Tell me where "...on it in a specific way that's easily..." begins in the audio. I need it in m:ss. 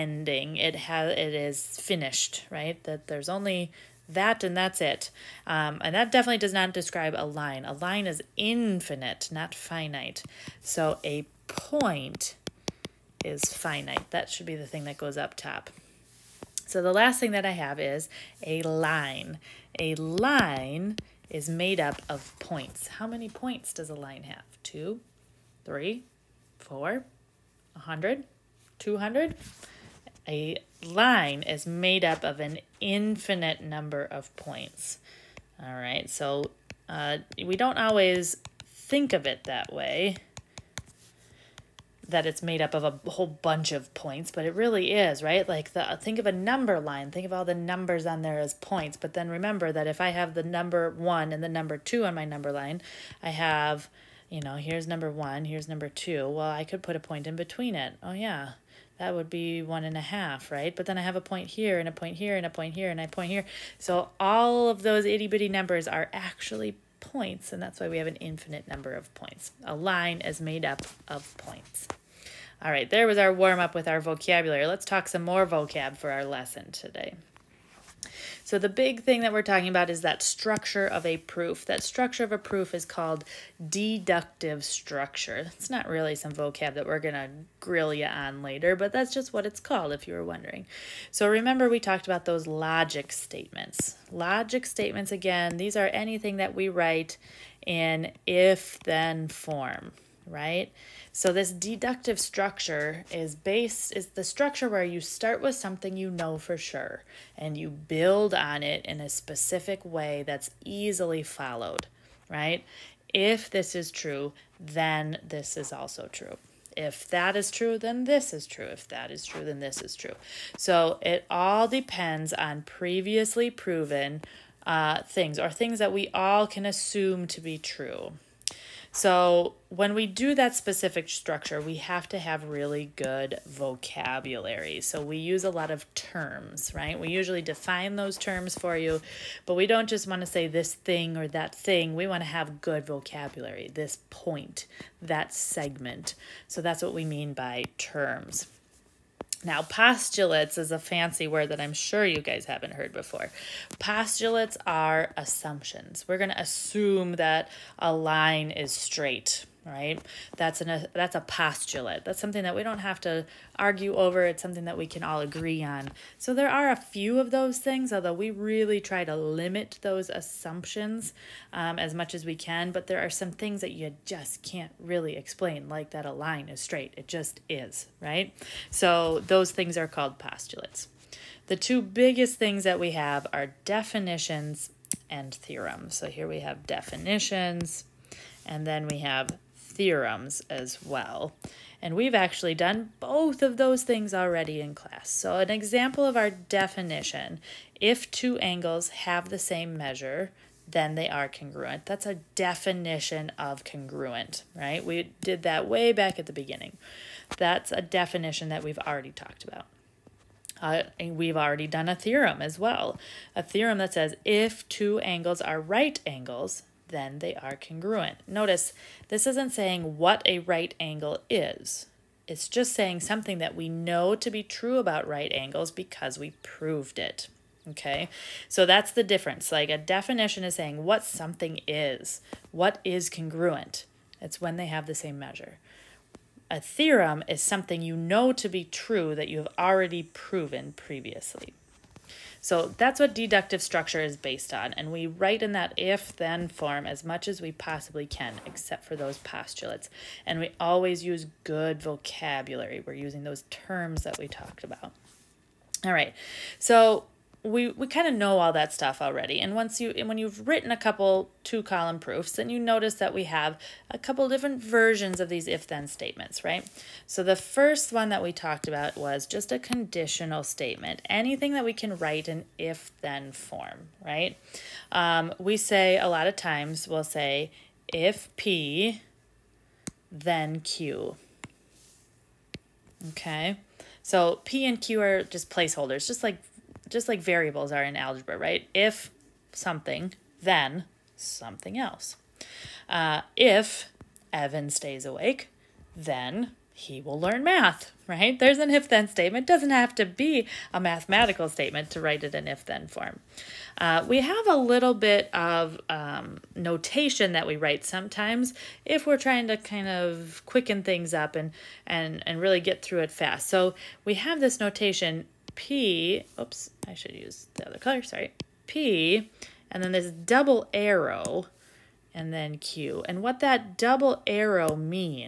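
1:48.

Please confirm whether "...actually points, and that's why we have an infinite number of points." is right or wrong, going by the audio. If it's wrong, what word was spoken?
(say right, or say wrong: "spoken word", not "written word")
right.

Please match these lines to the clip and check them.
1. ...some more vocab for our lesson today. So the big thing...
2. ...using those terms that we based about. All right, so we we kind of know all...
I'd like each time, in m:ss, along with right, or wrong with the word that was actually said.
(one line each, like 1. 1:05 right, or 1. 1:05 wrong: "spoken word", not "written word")
1. 1:15 right
2. 4:12 wrong: "talked", not "based".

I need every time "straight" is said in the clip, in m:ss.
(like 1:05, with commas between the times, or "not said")
2:38, 2:56.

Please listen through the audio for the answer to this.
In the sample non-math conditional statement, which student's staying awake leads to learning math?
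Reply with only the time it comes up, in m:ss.
4:54.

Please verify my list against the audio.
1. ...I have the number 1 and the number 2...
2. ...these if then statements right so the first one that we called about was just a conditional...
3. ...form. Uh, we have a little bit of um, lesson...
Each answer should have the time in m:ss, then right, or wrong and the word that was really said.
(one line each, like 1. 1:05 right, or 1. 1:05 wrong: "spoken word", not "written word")
1. 0:50 right
2. 4:25 wrong: "talked", not "called"
3. 5:02 wrong: "notation", not "lesson".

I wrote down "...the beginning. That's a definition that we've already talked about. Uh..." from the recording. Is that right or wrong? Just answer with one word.
right.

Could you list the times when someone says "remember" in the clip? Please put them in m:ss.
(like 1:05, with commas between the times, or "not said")
0:49, 1:31.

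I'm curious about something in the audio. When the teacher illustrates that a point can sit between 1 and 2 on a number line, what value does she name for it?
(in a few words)
one and a half.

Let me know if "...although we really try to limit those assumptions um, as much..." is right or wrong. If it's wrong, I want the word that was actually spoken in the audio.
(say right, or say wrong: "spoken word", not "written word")
right.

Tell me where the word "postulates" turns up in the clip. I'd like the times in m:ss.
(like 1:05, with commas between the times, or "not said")
2:29, 2:33, 2:41, 3:00, 4:09.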